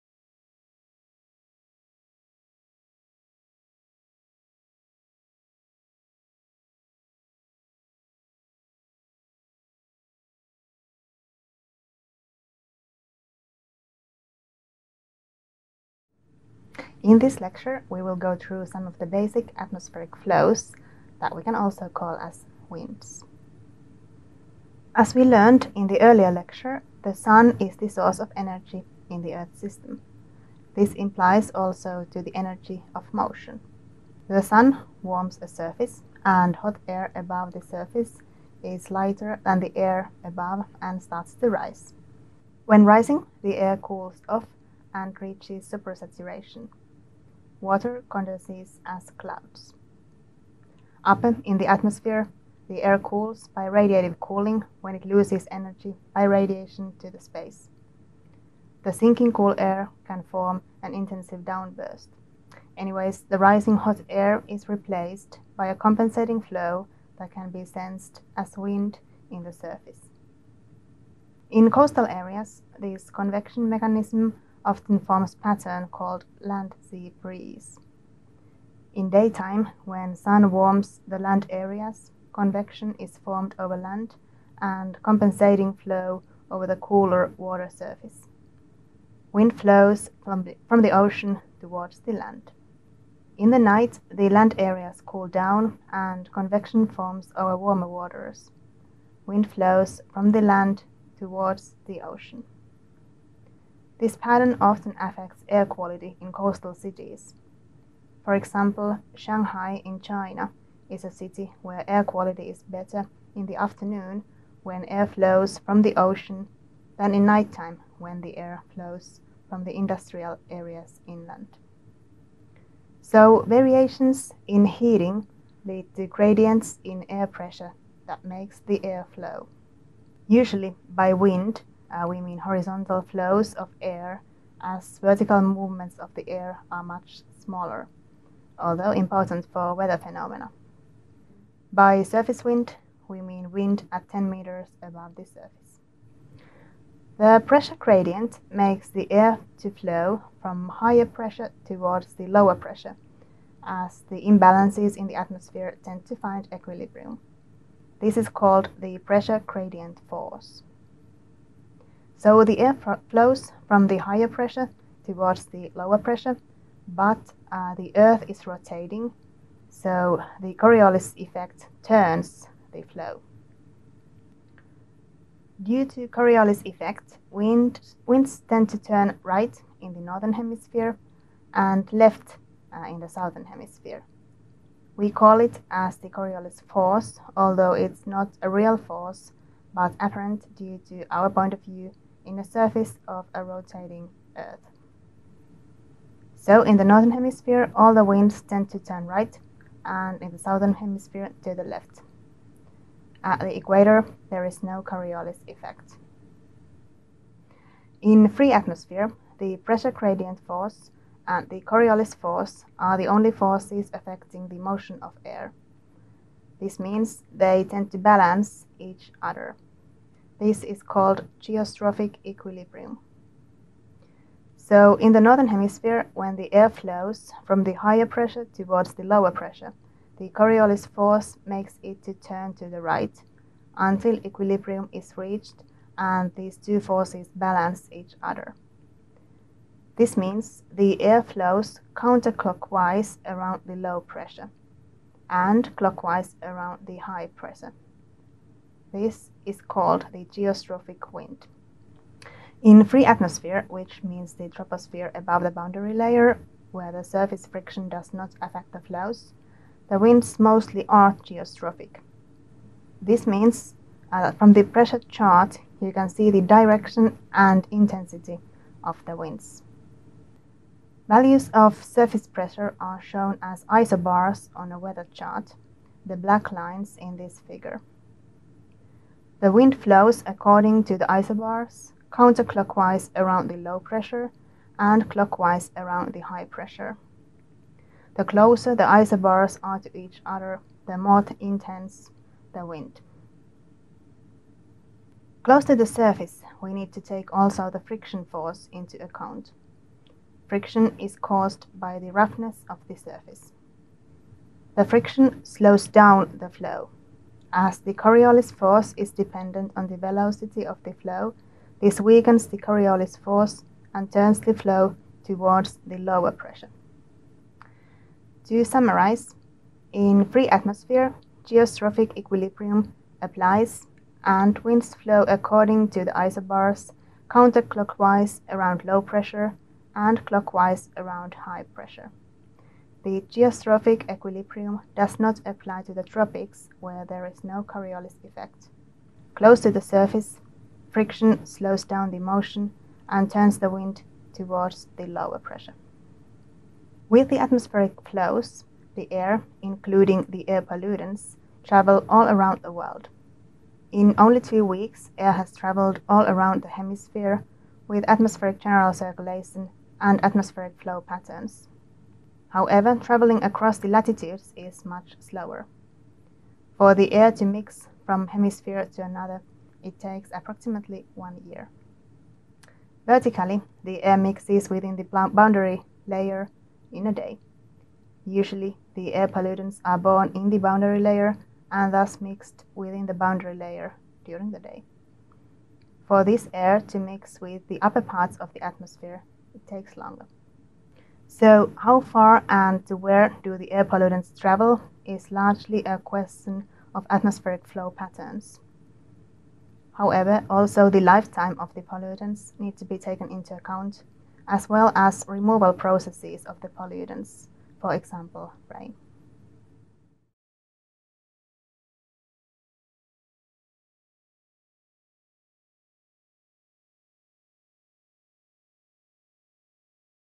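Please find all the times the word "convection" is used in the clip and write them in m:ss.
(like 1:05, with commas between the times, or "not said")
1:13, 1:22, 1:36.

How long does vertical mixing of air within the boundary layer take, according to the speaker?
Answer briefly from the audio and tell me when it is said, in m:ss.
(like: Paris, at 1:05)
a day, at 6:17.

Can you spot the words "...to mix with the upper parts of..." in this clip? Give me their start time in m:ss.
6:26.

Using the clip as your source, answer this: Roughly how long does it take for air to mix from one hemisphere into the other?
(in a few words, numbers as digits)
1 year.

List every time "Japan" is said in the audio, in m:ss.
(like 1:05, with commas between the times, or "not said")
not said.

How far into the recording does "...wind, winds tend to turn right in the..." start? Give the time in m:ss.
2:57.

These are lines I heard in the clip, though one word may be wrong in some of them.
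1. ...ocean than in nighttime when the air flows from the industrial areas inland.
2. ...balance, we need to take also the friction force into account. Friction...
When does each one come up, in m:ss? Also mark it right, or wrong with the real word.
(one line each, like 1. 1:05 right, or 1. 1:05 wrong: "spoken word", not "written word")
1. 1:55 right
2. 4:55 wrong: "surface", not "balance".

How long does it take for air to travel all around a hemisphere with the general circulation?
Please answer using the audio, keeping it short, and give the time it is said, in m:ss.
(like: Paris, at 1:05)
2 weeks, at 5:54.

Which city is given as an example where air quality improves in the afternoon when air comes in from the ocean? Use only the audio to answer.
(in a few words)
Shanghai.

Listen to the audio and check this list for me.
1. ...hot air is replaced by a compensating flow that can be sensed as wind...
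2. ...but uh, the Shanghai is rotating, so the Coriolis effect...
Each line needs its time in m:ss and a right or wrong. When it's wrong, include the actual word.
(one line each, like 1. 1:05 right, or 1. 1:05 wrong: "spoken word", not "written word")
1. 1:03 right
2. 2:46 wrong: "Earth", not "Shanghai".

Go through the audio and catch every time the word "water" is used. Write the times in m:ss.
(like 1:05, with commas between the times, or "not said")
0:47, 1:27, 1:37.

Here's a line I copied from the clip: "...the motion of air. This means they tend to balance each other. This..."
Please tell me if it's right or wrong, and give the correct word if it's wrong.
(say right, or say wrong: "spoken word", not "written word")
right.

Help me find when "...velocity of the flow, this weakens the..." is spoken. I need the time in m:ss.
5:09.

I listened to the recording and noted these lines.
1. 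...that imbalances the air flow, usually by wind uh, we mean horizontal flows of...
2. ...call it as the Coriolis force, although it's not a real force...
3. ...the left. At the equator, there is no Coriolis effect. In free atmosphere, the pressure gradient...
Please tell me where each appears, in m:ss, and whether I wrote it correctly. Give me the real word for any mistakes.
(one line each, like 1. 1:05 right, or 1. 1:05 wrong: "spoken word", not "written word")
1. 2:08 wrong: "makes", not "imbalances"
2. 3:05 right
3. 3:21 right.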